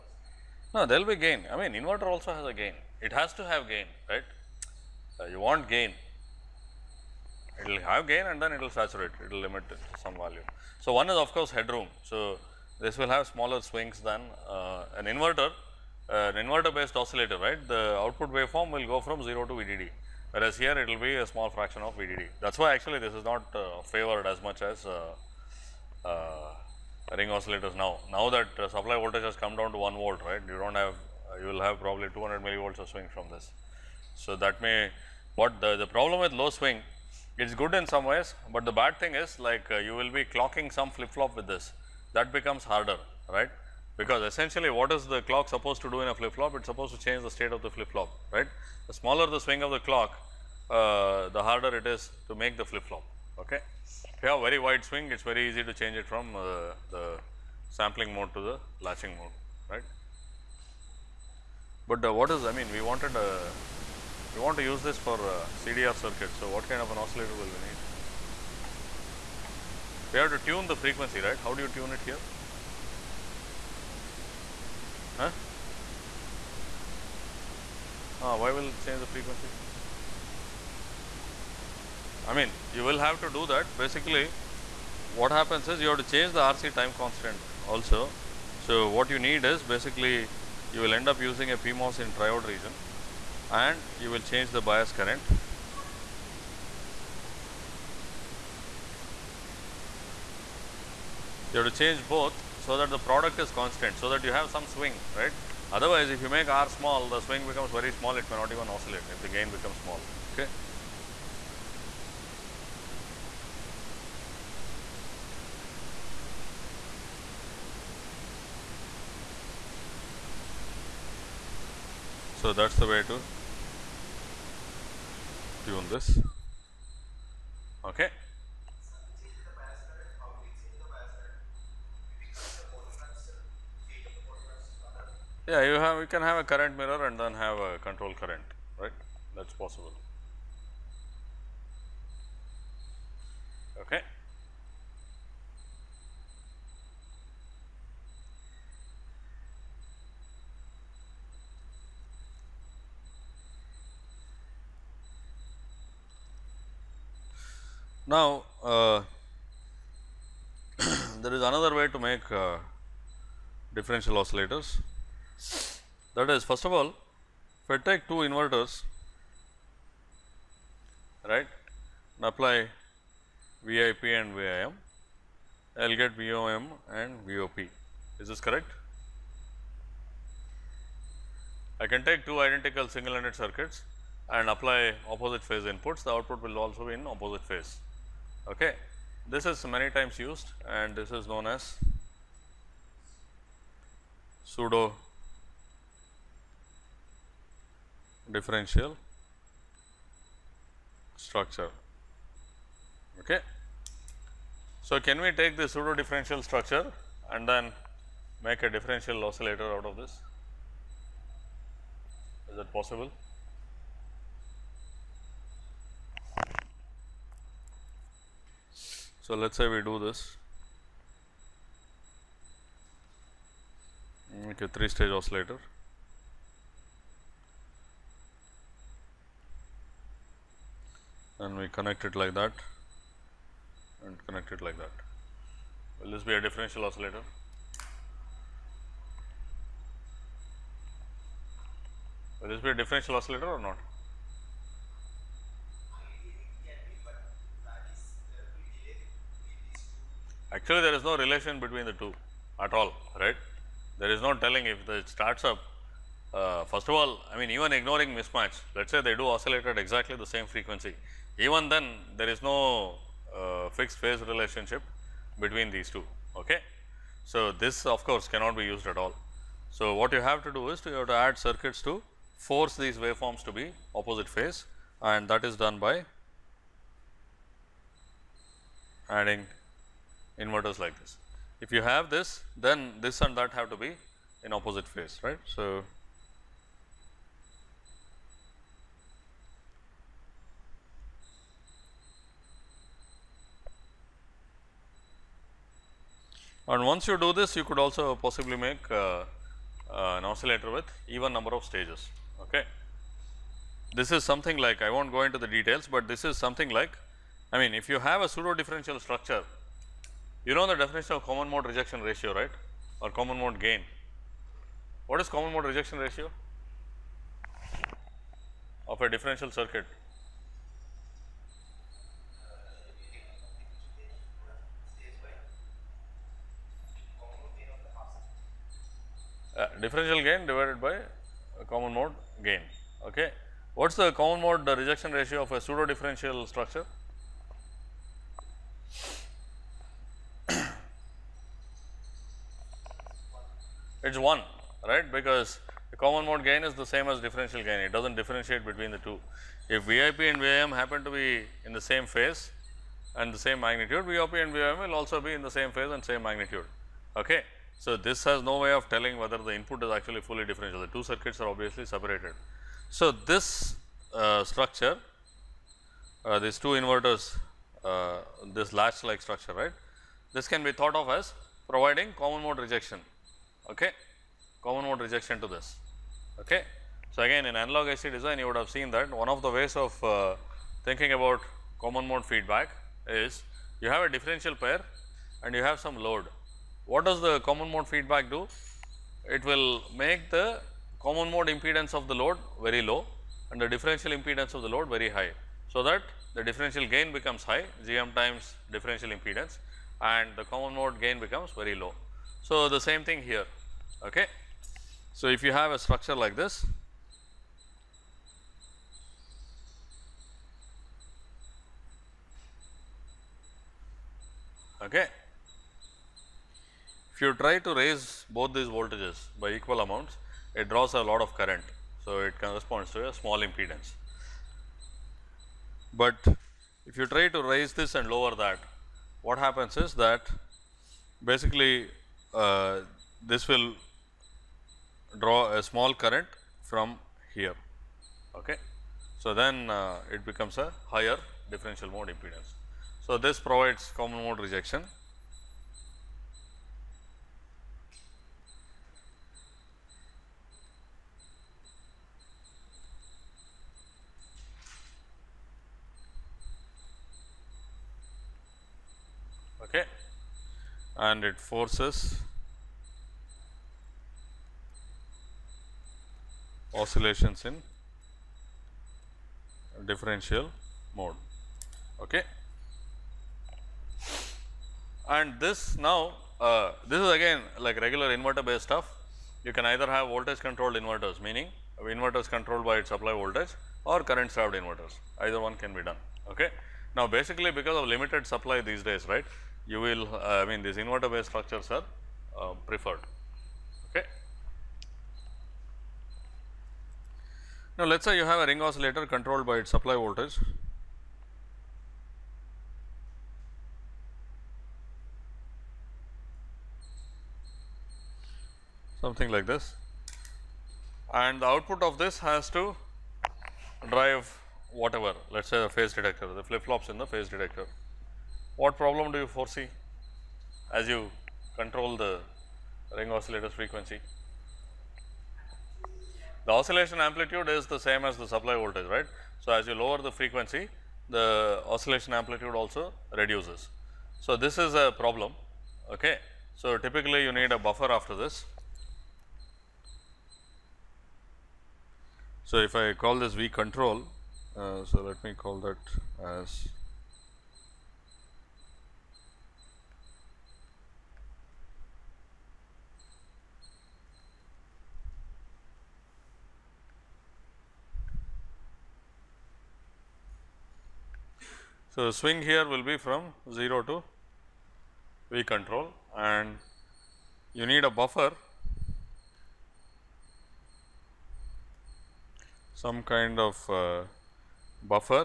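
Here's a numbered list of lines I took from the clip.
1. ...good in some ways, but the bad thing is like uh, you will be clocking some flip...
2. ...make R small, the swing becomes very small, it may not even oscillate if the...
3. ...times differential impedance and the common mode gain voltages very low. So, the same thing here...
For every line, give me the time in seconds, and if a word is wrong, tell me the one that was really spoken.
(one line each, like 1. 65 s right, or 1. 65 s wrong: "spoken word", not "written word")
1. 37 s right
2. 106 s right
3. 398 s wrong: "becomes", not "voltages".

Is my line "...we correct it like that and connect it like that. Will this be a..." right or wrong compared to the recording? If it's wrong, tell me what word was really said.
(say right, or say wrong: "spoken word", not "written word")
wrong: "connect", not "correct".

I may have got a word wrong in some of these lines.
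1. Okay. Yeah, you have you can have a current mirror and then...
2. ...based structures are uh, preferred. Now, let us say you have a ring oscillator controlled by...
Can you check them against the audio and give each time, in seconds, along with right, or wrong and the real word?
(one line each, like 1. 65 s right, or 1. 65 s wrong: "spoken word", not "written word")
1. 127 s right
2. 491 s right.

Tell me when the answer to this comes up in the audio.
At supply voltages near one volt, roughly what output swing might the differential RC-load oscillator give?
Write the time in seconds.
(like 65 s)
32 s.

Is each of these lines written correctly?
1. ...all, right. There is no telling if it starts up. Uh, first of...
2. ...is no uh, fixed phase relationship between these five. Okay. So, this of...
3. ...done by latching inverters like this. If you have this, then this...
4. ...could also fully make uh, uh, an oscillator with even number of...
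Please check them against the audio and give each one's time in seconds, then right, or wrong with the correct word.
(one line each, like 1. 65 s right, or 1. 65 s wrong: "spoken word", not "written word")
1. 252 s right
2. 262 s wrong: "two", not "five"
3. 275 s wrong: "adding", not "latching"
4. 297 s wrong: "possibly", not "fully".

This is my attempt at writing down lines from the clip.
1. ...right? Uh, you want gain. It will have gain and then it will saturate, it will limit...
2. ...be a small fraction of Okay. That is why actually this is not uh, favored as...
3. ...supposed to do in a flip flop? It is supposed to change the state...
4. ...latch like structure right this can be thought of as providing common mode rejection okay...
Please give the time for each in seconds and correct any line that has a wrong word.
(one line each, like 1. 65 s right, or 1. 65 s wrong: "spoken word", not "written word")
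1. 4 s right
2. 21 s wrong: "VDD", not "Okay"
3. 45 s right
4. 368 s right.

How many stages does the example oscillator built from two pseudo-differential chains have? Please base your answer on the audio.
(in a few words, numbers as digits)
three.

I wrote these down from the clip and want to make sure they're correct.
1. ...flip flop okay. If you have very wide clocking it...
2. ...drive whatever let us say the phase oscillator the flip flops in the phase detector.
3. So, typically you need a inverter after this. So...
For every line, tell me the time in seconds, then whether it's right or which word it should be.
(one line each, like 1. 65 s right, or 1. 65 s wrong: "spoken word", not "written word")
1. 52 s wrong: "swing", not "clocking"
2. 513 s wrong: "detector", not "oscillator"
3. 536 s wrong: "buffer", not "inverter".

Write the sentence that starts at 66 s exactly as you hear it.
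So, what kind of an oscillator will we need?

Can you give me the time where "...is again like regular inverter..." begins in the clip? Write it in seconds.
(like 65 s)
477 s.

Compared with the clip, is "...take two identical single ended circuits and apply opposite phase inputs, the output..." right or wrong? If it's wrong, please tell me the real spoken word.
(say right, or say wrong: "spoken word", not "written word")
right.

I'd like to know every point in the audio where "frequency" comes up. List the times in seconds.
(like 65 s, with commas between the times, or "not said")
70 s, 79 s, 260 s, 523 s, 530 s.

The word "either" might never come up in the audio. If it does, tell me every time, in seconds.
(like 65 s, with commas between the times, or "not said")
479 s, 485 s.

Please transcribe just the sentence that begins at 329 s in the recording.
Uh, differential gain divided by common mode gain.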